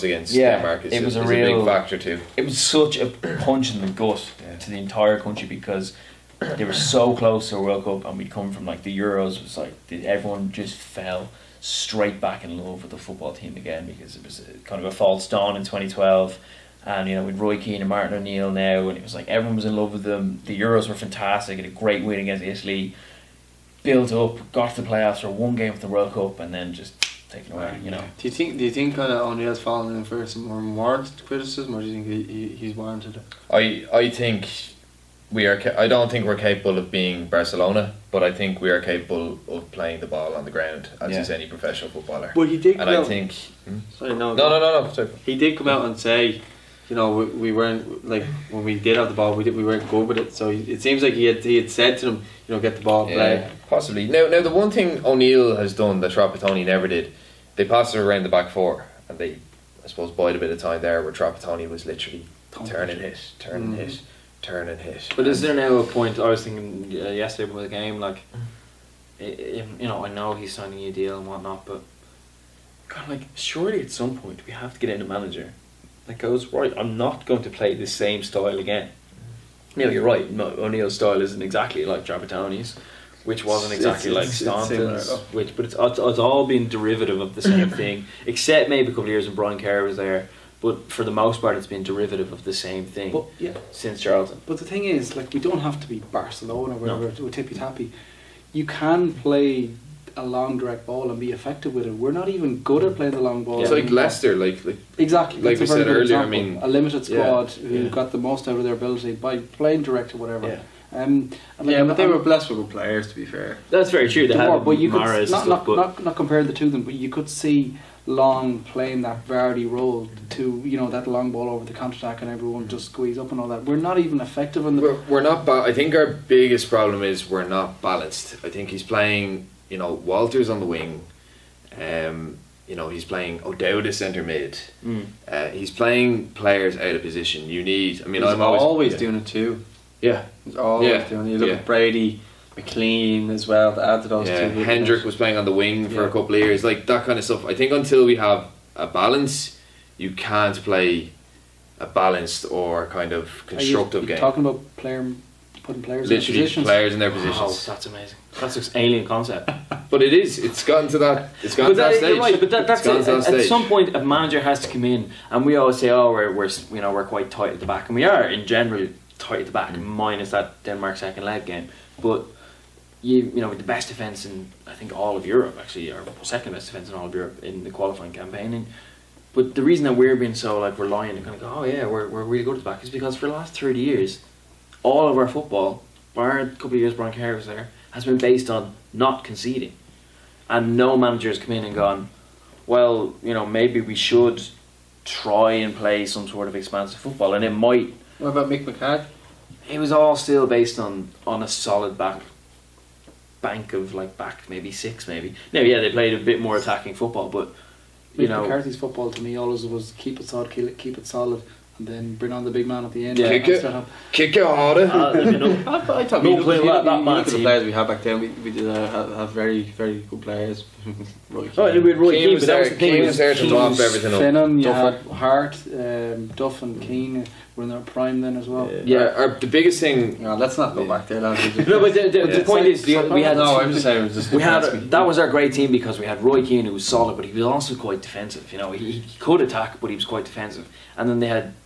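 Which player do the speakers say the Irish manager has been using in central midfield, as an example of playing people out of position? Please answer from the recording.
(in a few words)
O'Dowda.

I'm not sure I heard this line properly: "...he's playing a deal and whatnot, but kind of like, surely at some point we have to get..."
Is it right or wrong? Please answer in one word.
wrong.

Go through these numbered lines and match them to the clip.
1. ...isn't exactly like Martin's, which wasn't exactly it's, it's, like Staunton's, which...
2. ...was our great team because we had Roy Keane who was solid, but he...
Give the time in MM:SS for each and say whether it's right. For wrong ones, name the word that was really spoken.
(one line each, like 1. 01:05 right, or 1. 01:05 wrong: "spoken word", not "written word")
1. 01:21 wrong: "Trapattoni", not "Martin"
2. 03:55 right.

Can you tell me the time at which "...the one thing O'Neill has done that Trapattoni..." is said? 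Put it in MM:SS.
00:54.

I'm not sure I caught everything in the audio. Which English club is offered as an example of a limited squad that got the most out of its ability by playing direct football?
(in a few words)
Leicester.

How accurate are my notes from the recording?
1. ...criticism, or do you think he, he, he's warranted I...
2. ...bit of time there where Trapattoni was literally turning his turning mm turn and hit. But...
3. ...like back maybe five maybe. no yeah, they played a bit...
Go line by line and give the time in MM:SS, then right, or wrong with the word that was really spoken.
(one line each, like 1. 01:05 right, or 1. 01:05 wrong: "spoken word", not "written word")
1. 00:31 right
2. 01:00 right
3. 03:23 wrong: "six", not "five".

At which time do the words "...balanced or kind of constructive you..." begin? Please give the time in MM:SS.
02:31.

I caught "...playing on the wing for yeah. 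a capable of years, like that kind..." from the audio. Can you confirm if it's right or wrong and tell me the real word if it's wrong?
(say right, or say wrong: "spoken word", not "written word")
wrong: "couple", not "capable".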